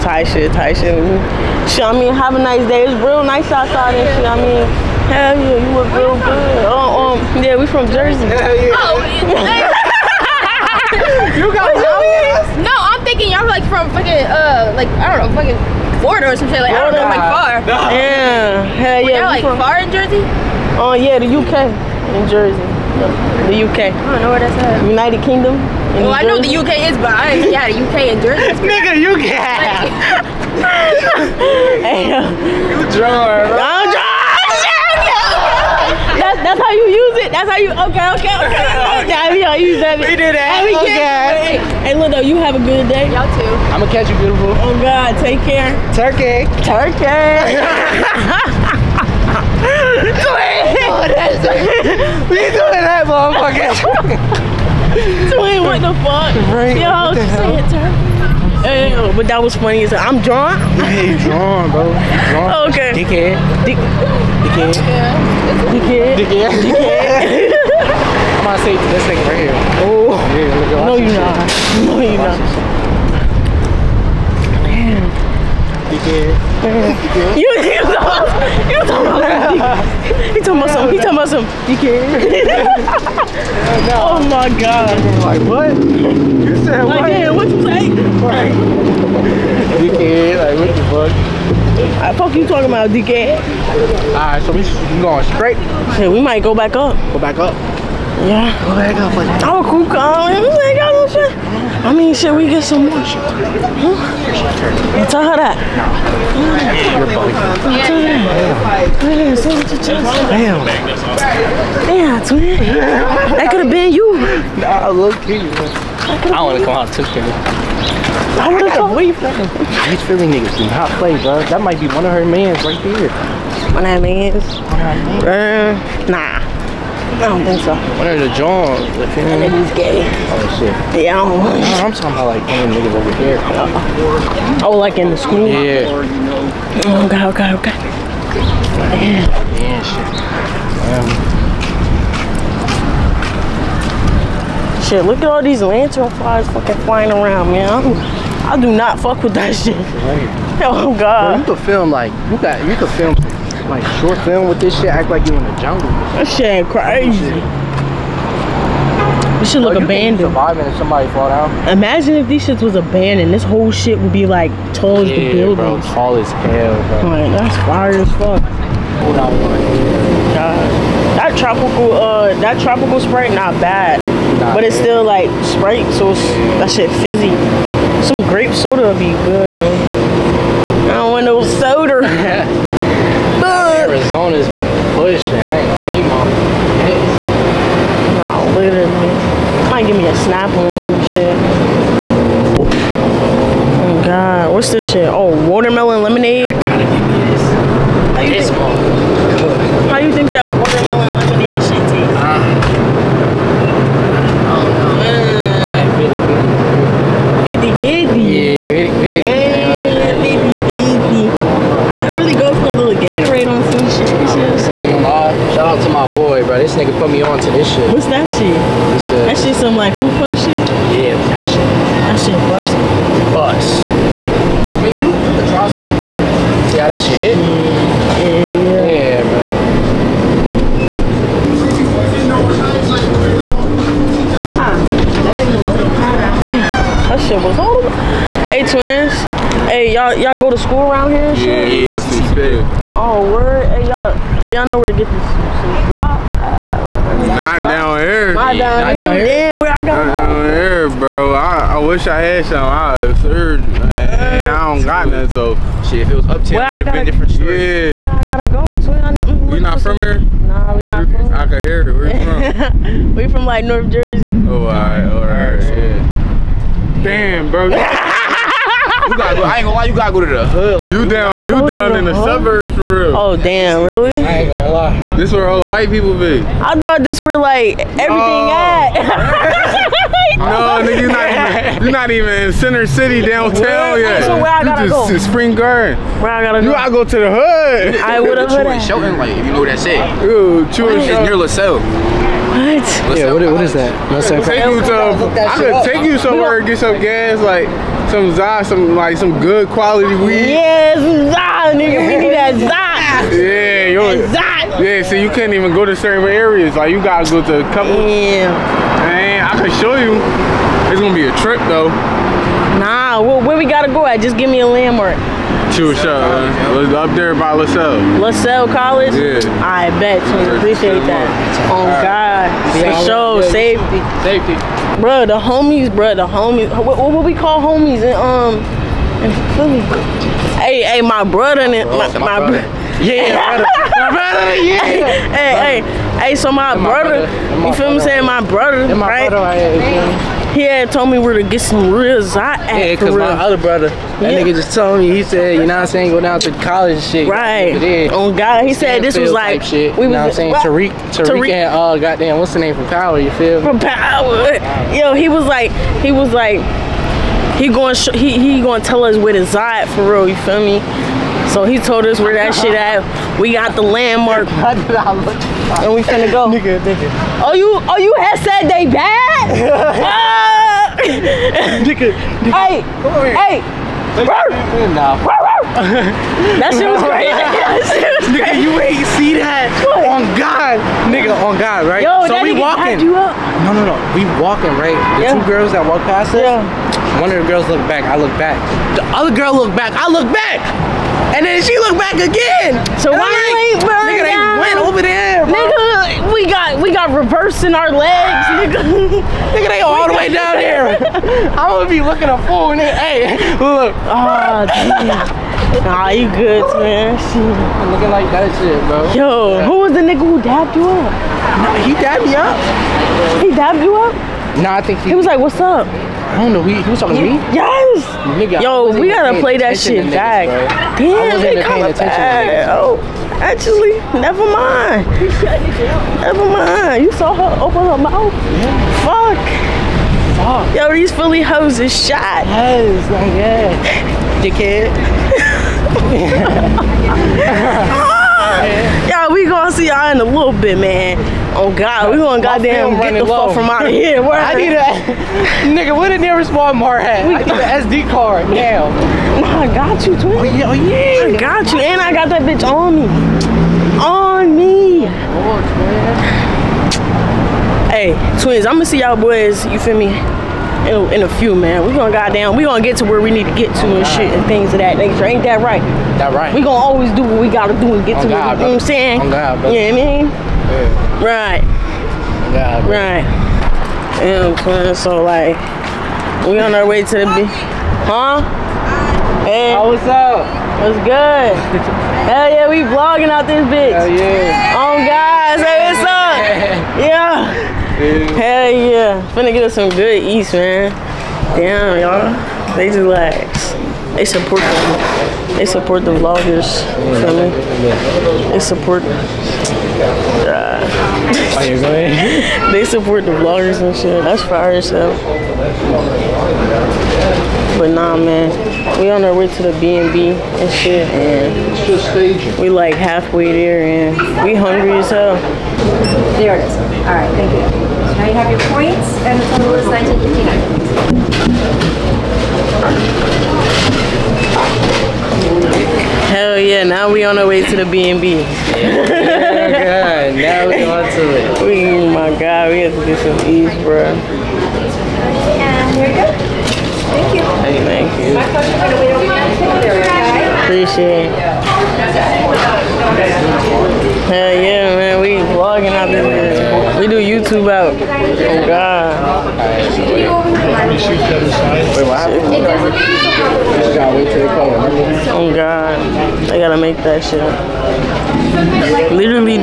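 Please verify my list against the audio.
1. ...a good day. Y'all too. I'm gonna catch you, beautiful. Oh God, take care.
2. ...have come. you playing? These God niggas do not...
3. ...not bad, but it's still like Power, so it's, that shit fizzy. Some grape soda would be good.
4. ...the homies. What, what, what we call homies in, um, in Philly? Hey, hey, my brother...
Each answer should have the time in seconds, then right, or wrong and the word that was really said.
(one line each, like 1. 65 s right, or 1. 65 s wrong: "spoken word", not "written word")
1. 42 s right
2. 118 s wrong: "Philly", not "God"
3. 173 s wrong: "Sprite", not "Power"
4. 326 s right.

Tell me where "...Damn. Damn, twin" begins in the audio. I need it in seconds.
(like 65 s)
110 s.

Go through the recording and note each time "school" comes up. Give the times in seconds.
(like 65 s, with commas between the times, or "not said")
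135 s, 240 s.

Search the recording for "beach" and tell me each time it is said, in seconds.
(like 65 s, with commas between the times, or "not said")
477 s.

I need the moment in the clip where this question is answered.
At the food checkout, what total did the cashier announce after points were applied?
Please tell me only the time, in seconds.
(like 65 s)
519 s.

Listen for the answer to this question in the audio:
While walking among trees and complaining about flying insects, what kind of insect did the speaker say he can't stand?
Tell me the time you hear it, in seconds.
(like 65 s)
145 s.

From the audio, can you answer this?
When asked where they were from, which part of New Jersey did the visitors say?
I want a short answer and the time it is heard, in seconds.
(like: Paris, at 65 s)
North Jersey, at 263 s.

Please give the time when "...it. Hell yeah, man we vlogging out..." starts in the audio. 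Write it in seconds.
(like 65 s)
541 s.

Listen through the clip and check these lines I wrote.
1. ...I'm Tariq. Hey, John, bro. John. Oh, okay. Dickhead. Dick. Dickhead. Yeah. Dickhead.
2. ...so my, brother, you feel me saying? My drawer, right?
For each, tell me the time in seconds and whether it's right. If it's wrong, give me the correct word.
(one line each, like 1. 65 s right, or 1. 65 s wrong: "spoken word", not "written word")
1. 59 s wrong: "John", not "Tariq"
2. 336 s wrong: "brother", not "drawer".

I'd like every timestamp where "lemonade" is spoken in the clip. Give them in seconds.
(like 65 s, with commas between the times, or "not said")
196 s, 201 s.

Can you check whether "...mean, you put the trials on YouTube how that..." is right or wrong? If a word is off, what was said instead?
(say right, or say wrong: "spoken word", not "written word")
wrong: "See", not "YouTube".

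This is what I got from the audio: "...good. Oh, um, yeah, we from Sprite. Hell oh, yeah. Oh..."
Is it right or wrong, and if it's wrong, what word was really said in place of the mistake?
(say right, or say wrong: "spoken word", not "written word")
wrong: "Jersey", not "Sprite".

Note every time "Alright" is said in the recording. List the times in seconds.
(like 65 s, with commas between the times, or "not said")
94 s.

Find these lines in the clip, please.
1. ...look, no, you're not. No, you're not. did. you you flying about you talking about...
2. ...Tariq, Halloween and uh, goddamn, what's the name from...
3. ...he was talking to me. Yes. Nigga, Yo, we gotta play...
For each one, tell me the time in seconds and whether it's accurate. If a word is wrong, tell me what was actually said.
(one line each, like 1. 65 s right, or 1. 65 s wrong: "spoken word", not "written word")
1. 70 s wrong: "talking", not "flying"
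2. 351 s wrong: "Tariq", not "Halloween"
3. 416 s right.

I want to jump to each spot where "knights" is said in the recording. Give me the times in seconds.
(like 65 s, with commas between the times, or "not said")
not said.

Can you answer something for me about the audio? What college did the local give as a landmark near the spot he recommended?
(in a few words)
LaSalle College.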